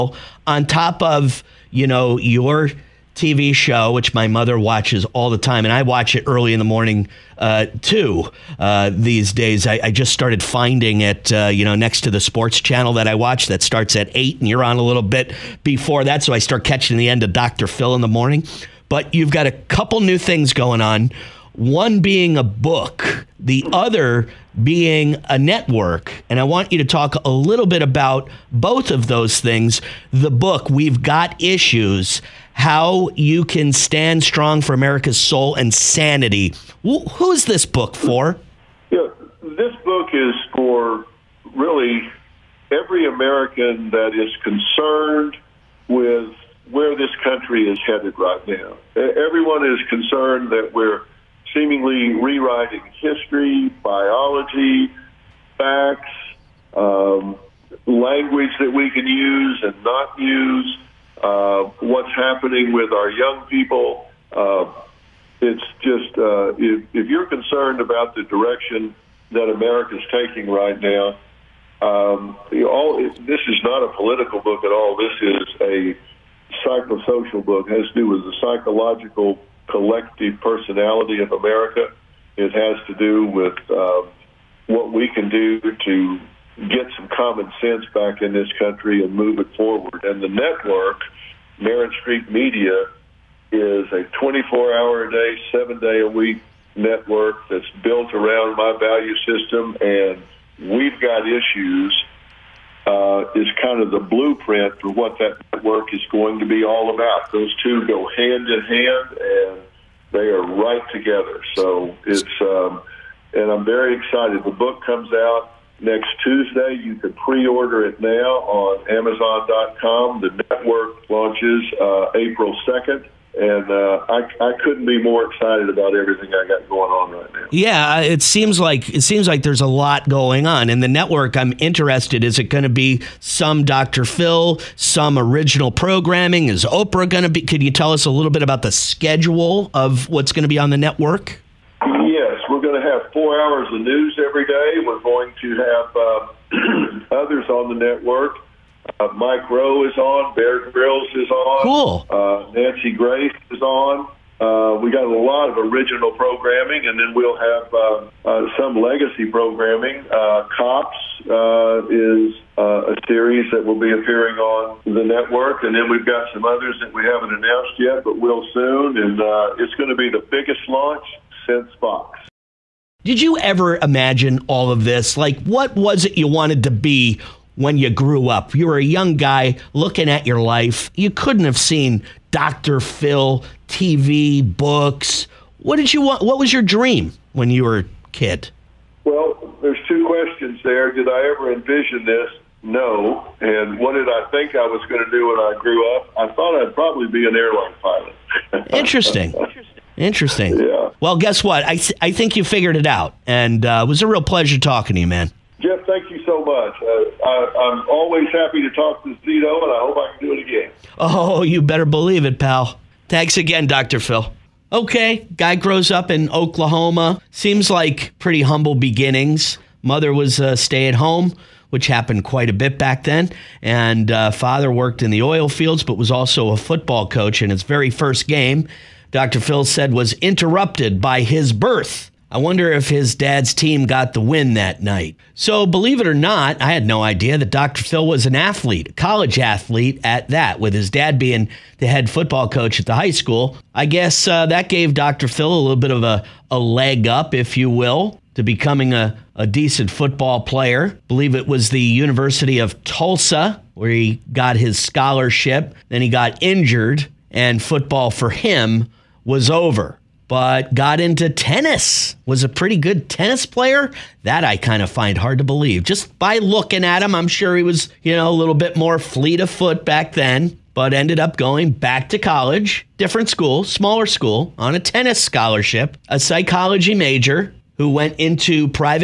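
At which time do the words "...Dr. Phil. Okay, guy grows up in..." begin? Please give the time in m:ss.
3:33.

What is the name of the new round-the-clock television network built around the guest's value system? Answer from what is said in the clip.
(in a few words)
Merit Street Media.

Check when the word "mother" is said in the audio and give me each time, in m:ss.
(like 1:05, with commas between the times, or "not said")
0:04, 3:39.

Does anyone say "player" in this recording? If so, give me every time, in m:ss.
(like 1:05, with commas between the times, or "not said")
4:10, 4:23.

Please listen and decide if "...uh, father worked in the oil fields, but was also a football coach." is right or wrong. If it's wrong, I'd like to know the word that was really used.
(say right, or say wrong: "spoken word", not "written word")
right.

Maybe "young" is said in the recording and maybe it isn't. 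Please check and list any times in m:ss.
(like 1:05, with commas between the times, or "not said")
1:03, 2:58.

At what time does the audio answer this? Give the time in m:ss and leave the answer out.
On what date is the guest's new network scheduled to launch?
2:02.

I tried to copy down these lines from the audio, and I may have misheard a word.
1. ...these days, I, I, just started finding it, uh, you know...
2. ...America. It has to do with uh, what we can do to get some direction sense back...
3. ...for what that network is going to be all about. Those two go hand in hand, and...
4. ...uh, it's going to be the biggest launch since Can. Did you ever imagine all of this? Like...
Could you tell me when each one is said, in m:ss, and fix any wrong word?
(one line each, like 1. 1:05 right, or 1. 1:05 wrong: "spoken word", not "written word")
1. 0:08 right
2. 1:21 wrong: "common", not "direction"
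3. 1:44 right
4. 2:49 wrong: "Fox", not "Can".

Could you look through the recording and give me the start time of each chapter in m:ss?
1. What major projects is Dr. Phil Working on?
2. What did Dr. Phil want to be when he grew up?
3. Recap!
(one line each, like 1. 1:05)
1. 0:17
2. 2:53
3. 3:35.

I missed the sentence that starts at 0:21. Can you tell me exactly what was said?
One being a book, the other being a network.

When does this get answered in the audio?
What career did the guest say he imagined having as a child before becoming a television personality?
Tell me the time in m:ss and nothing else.
3:17.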